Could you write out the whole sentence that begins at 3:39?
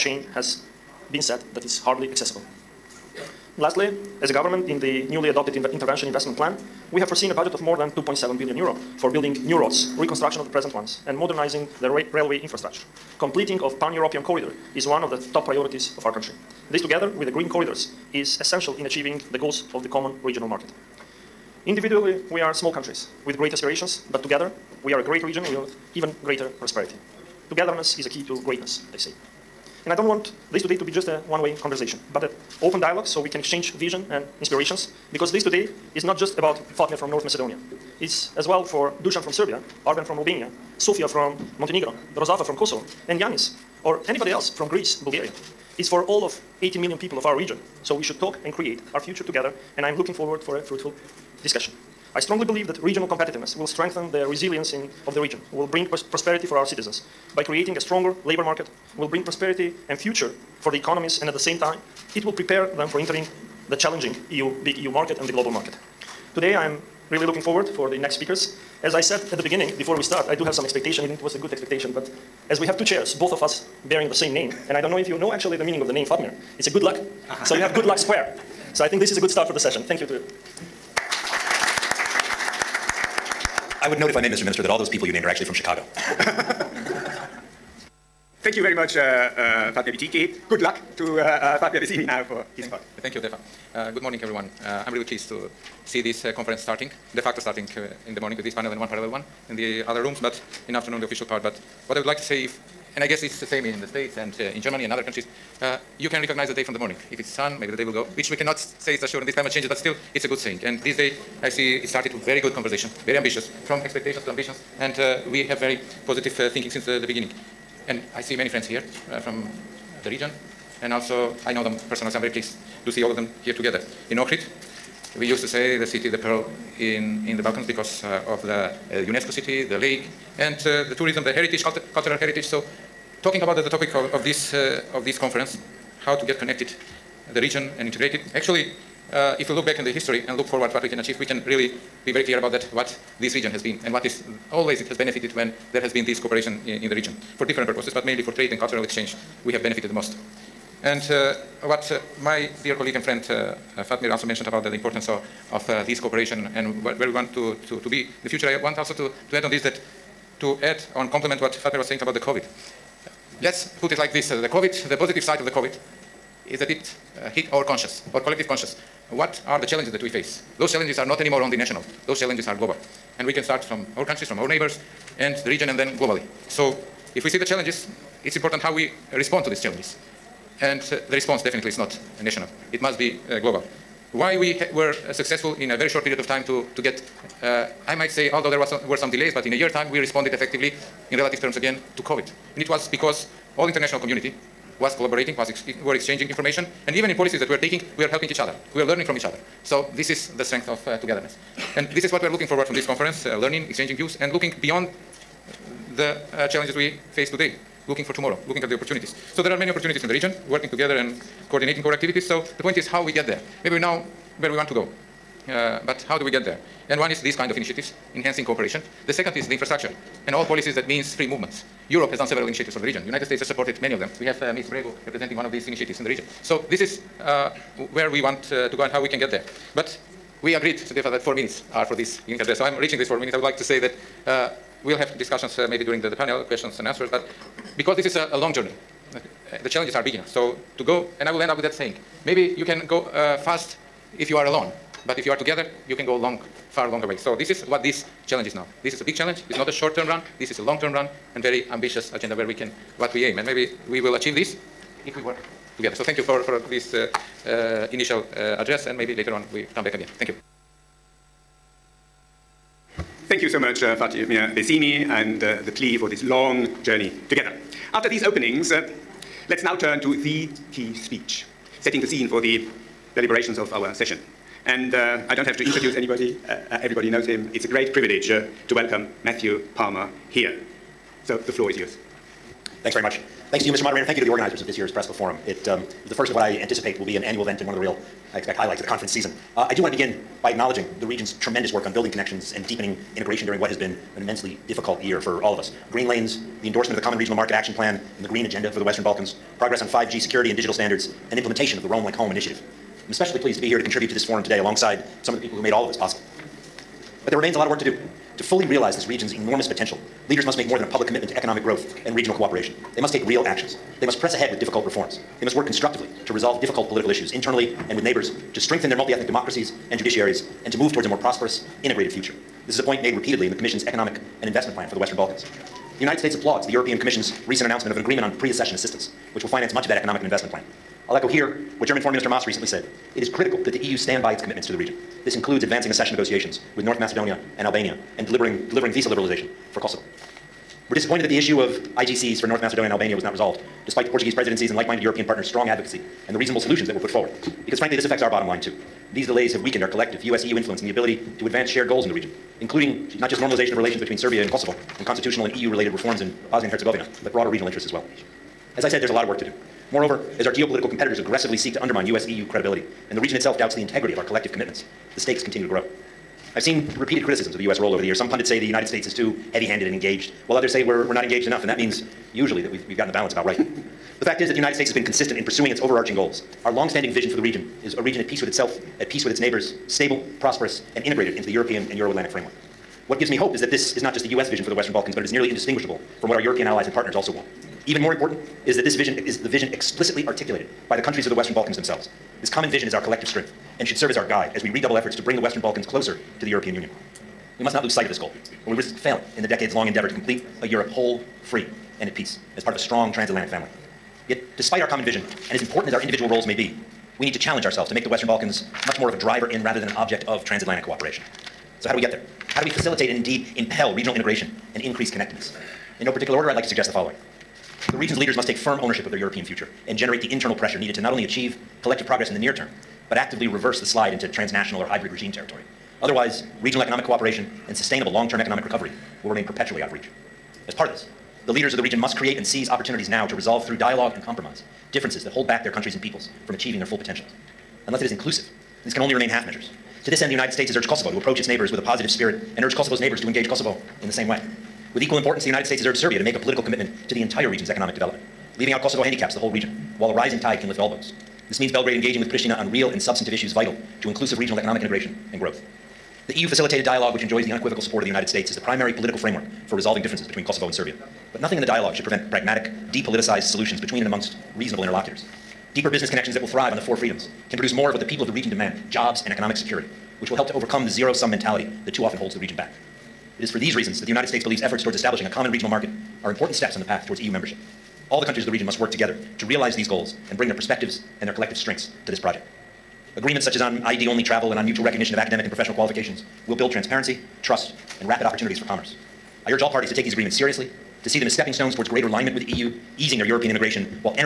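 The second is the infrastructure and all policies that means free movements.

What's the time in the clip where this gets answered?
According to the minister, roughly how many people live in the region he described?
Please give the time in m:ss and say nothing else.
0:46.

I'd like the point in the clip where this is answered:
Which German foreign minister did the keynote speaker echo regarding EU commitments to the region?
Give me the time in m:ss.
5:32.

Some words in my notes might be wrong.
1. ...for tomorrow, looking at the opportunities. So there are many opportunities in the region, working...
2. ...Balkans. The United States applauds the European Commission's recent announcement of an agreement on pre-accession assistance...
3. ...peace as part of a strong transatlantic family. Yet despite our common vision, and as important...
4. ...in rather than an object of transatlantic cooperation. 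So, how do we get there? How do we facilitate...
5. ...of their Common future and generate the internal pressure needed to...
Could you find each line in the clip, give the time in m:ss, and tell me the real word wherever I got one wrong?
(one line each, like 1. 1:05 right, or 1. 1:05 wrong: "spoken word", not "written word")
1. 3:28 right
2. 5:25 right
3. 6:42 right
4. 6:49 right
5. 6:59 wrong: "European", not "Common".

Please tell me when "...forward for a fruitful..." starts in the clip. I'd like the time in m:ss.
0:50.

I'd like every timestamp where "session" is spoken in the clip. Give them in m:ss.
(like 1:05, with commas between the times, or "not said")
1:19, 4:33.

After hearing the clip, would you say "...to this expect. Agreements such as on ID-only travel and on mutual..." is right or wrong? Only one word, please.
wrong.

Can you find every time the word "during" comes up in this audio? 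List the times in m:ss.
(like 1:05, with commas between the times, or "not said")
3:55, 4:53.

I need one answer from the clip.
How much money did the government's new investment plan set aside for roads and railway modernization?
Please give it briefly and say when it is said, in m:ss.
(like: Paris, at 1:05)
more than 2.7 billion euro, at 0:07.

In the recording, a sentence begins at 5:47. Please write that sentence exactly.
Because frankly, this affects our bottom line too.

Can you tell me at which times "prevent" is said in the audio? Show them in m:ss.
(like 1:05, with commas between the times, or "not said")
7:42.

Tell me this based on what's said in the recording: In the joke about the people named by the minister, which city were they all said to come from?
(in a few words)
Chicago.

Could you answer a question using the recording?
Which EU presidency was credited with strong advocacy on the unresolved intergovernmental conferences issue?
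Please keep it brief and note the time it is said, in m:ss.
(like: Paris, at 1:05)
Portuguese presidency, at 5:44.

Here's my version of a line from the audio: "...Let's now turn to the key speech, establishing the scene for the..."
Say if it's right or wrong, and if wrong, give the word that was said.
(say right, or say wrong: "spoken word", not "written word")
wrong: "setting", not "establishing".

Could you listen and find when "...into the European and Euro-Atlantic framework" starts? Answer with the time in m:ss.
6:21.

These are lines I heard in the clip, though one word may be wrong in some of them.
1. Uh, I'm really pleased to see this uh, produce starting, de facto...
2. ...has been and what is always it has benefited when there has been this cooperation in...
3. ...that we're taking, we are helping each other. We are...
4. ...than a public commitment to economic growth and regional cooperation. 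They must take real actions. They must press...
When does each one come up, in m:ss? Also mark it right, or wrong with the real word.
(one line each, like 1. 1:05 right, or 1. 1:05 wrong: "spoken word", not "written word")
1. 1:34 wrong: "conference", not "produce"
2. 2:23 right
3. 3:17 right
4. 5:10 right.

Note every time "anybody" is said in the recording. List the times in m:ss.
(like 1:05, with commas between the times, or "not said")
0:44, 4:35.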